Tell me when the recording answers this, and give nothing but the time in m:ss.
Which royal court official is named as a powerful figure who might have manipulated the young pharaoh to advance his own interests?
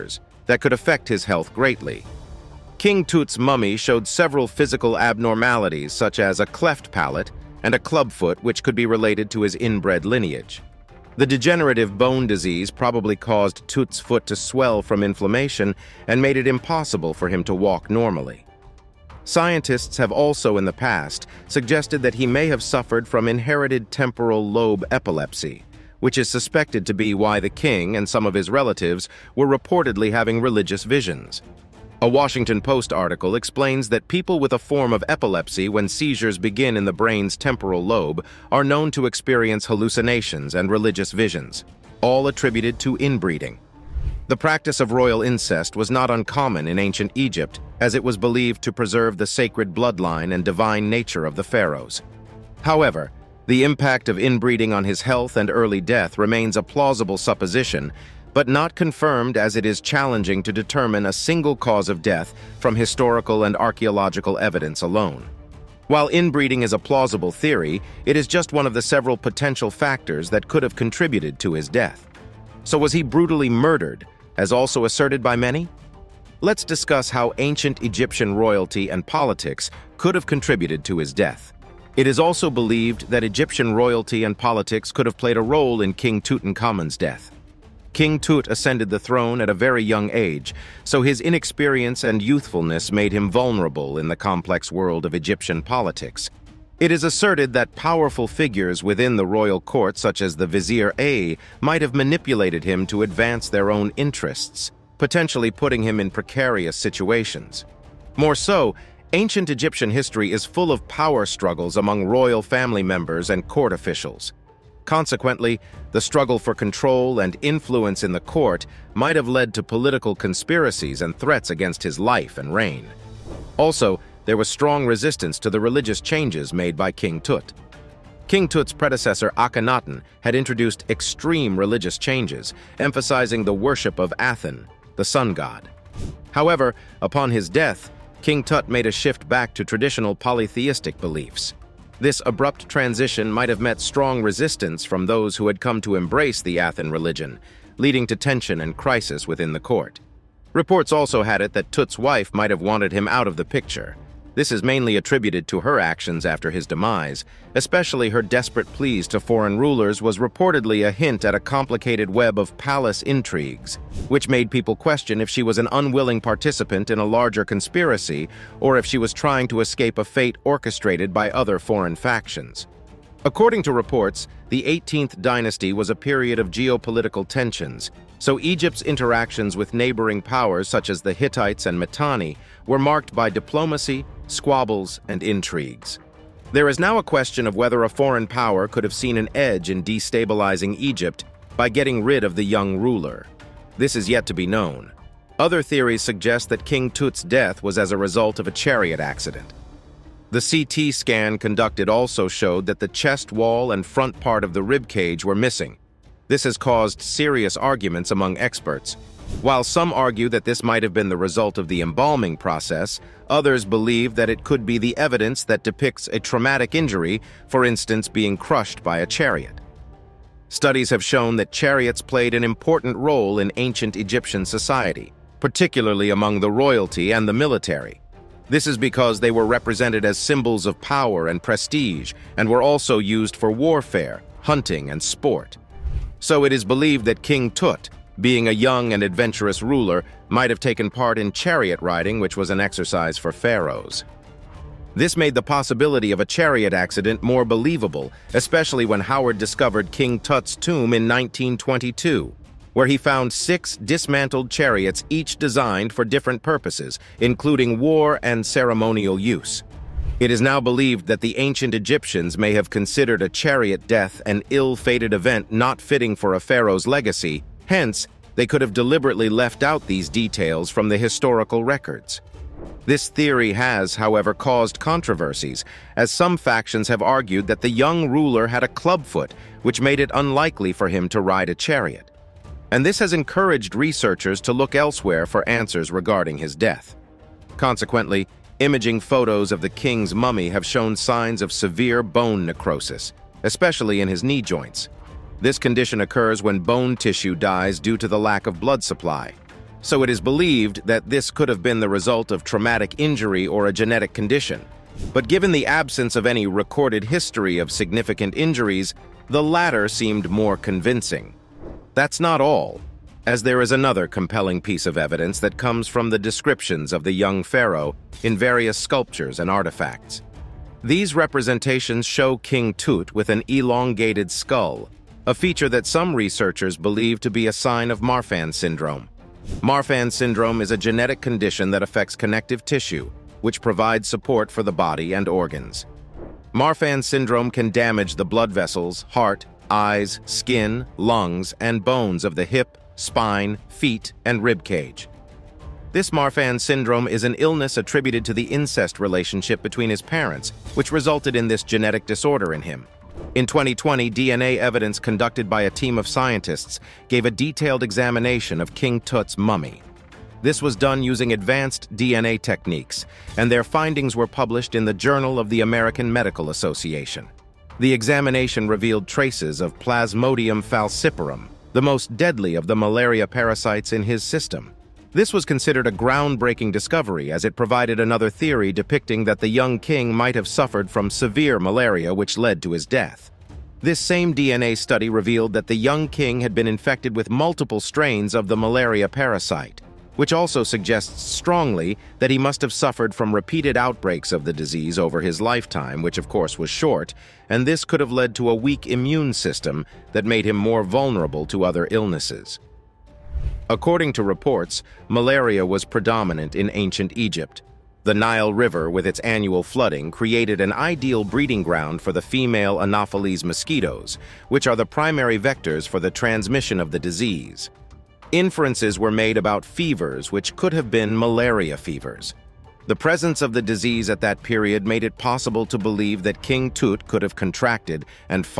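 1:40.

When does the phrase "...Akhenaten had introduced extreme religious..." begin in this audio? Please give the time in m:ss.
2:09.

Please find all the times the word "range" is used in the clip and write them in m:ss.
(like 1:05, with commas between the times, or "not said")
not said.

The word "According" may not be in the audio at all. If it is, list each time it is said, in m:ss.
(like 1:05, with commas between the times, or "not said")
2:53, 6:43.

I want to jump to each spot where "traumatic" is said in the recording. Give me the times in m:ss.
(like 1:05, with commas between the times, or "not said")
3:36, 5:02.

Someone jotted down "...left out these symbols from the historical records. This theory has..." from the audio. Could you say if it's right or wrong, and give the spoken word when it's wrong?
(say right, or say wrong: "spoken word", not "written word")
wrong: "details", not "symbols".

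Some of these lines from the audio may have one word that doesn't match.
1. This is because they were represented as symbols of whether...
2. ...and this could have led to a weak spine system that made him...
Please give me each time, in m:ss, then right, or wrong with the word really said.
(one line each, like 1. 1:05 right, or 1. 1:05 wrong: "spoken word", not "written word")
1. 3:48 wrong: "power", not "whether"
2. 6:37 wrong: "immune", not "spine".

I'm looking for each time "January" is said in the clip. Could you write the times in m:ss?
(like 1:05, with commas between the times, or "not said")
not said.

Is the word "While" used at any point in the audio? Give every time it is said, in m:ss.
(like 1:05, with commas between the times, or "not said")
1:05, 3:29.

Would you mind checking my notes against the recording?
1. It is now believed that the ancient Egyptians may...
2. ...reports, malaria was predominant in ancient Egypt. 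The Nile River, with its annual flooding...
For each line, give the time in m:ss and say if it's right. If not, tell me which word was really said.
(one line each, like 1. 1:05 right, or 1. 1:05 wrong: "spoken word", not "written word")
1. 4:20 right
2. 6:44 right.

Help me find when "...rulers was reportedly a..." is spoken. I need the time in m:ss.
2:39.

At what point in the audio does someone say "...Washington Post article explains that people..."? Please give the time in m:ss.
0:32.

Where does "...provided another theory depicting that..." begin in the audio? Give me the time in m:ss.
6:17.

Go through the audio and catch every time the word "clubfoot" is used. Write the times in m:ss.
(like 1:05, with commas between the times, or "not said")
0:07, 4:38.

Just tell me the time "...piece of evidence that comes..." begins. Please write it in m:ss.
5:14.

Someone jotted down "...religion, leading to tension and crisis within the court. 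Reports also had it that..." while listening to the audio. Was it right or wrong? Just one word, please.
right.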